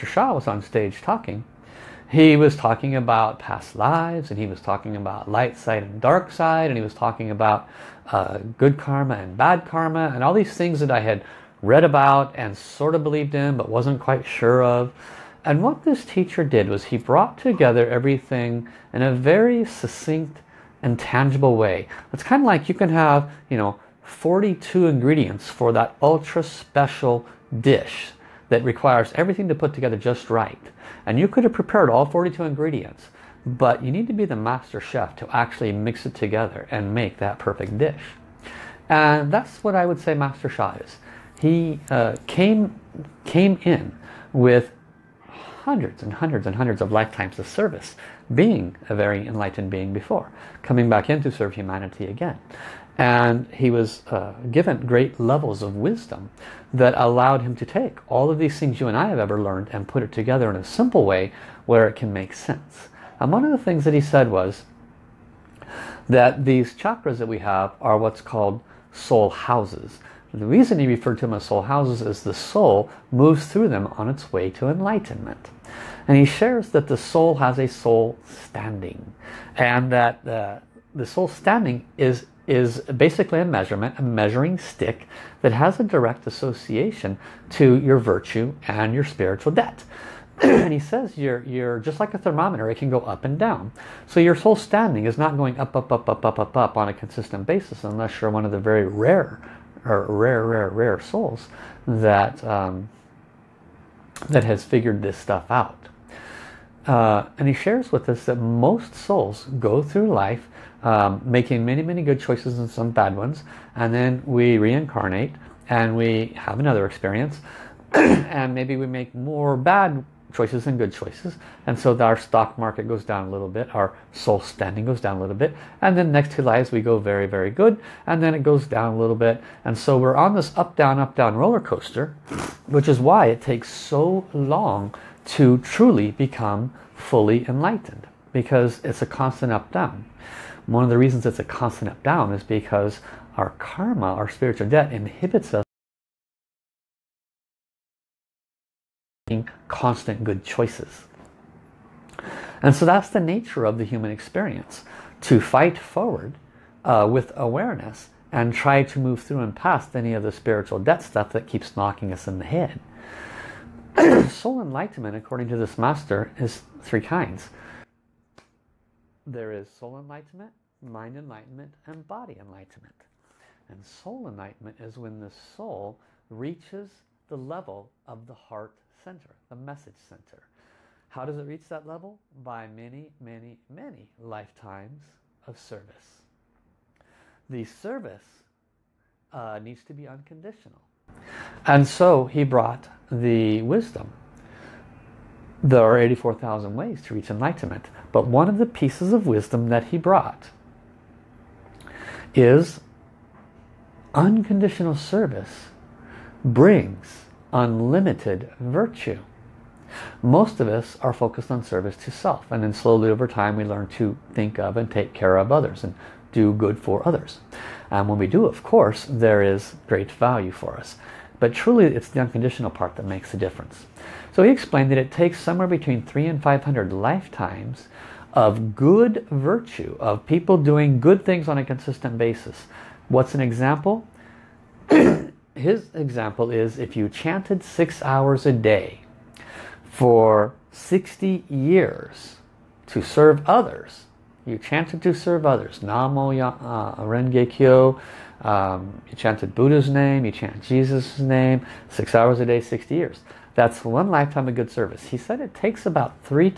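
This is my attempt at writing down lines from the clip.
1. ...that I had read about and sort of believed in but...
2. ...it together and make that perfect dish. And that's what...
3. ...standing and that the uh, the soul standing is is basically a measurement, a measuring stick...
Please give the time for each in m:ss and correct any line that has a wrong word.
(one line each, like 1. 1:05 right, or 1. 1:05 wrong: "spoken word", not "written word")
1. 0:10 right
2. 0:36 right
3. 1:18 right.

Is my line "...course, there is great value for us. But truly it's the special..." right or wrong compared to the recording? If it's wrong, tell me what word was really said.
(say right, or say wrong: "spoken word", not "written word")
wrong: "unconditional", not "special".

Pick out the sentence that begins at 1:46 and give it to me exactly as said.
Uh, and he shares with us that most souls go through life um, making many, many good choices and some bad ones.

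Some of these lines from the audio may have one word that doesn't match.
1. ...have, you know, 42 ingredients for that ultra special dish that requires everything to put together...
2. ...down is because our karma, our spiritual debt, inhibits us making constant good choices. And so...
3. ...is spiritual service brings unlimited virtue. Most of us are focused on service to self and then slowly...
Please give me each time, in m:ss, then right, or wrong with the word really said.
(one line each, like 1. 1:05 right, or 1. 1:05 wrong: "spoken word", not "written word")
1. 0:22 right
2. 2:22 right
3. 3:22 wrong: "unconditional", not "spiritual".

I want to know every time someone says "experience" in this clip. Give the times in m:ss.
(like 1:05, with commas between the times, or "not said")
1:56, 2:34.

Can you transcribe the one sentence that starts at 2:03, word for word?
Our soul standing goes down a little bit.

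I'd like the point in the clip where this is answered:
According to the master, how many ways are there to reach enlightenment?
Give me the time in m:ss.
3:15.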